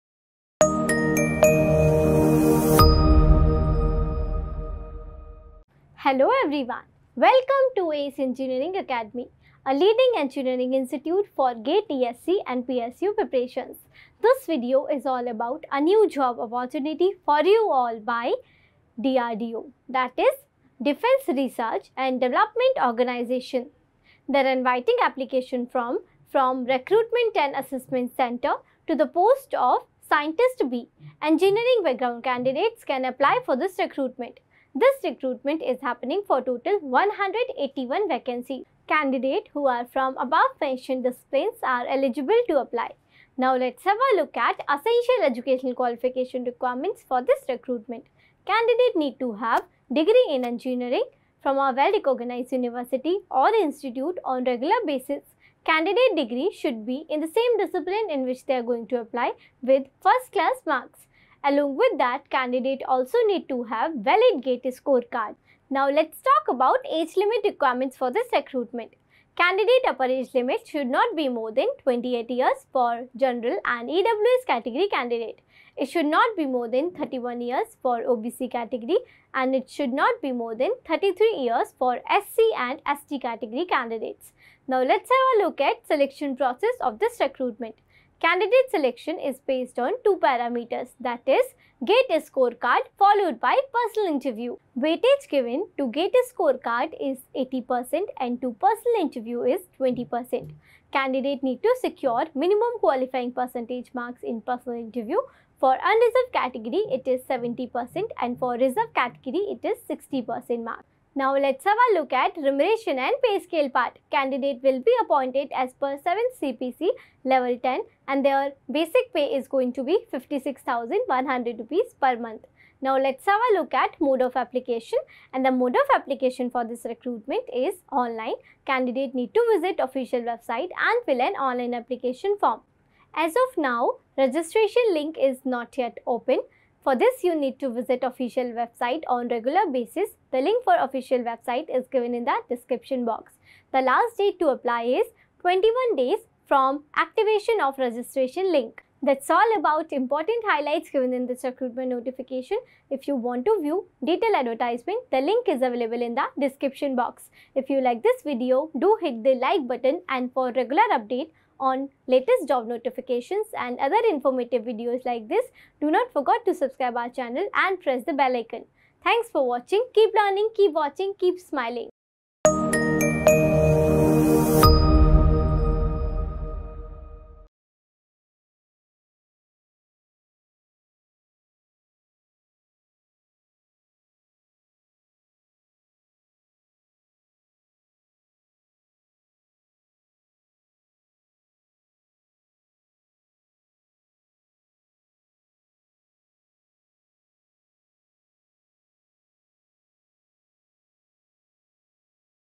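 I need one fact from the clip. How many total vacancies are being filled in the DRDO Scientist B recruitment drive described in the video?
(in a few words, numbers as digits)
181.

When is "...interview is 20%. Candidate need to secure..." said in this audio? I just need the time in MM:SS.
01:39.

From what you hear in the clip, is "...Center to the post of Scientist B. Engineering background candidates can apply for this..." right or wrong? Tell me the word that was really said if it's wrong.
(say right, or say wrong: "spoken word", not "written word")
right.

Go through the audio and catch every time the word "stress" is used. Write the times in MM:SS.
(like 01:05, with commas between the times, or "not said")
not said.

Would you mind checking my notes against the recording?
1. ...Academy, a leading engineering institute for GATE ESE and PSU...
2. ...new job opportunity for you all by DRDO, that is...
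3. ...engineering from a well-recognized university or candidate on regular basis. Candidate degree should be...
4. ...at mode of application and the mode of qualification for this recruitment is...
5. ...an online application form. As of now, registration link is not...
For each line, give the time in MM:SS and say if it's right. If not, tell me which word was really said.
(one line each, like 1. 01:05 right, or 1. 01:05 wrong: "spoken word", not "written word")
1. 00:08 right
2. 00:15 right
3. 00:50 wrong: "institute", not "candidate"
4. 02:03 wrong: "application", not "qualification"
5. 02:11 right.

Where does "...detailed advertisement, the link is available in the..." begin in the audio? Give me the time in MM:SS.
02:34.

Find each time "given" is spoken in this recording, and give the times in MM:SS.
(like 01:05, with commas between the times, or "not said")
01:35, 02:21, 02:30.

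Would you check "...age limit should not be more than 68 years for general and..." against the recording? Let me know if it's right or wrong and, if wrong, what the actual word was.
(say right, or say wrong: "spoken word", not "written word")
wrong: "28", not "68".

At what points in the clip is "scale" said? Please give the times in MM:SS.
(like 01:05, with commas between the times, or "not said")
01:53.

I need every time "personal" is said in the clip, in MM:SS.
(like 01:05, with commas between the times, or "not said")
01:33, 01:38, 01:44.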